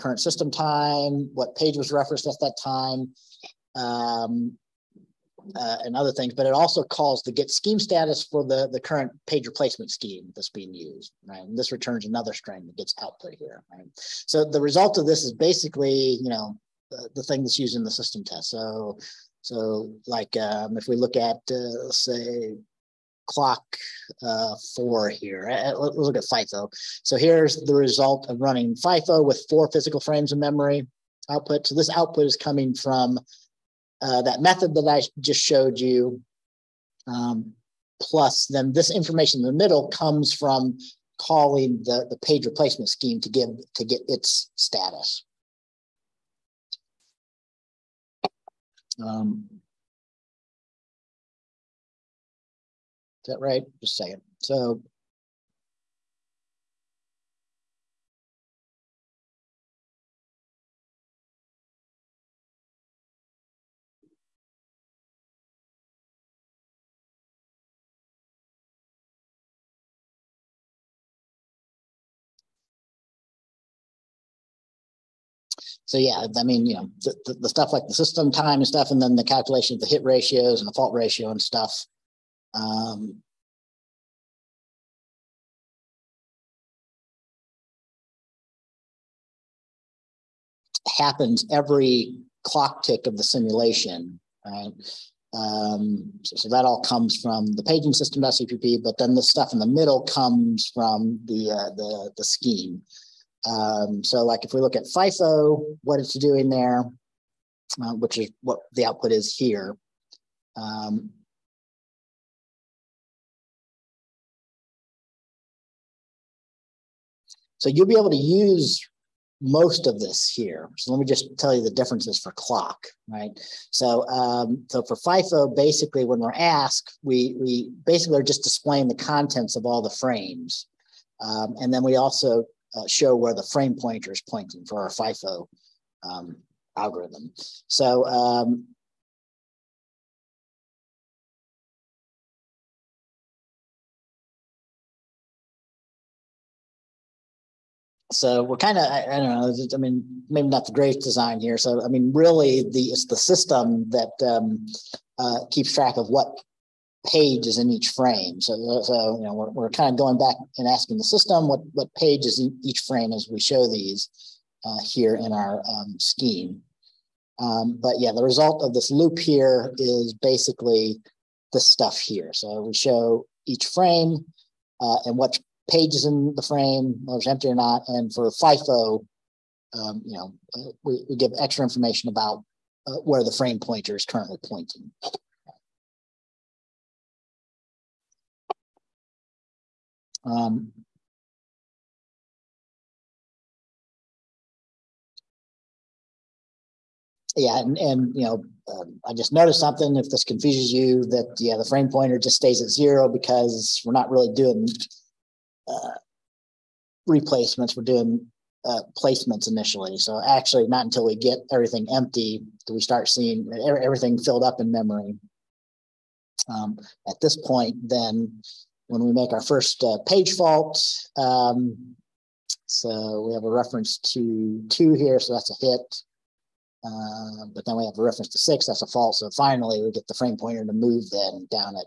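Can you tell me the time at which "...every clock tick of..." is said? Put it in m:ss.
1:31.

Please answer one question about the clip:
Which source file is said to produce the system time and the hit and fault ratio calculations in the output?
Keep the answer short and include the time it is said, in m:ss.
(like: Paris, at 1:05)
system.cpp, at 1:38.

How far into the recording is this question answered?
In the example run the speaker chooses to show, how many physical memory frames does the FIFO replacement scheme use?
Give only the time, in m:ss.
0:29.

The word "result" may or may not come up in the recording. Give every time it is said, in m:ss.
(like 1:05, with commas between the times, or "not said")
0:14, 0:27, 2:48.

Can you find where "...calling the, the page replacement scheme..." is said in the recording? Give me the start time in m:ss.
0:41.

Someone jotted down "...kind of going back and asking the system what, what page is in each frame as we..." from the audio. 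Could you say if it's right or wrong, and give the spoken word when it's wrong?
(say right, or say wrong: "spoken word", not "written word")
right.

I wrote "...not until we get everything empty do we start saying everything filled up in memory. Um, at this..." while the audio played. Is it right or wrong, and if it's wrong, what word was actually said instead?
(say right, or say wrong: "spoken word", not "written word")
wrong: "seeing", not "saying".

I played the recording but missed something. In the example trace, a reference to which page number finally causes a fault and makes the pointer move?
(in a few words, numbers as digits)
6.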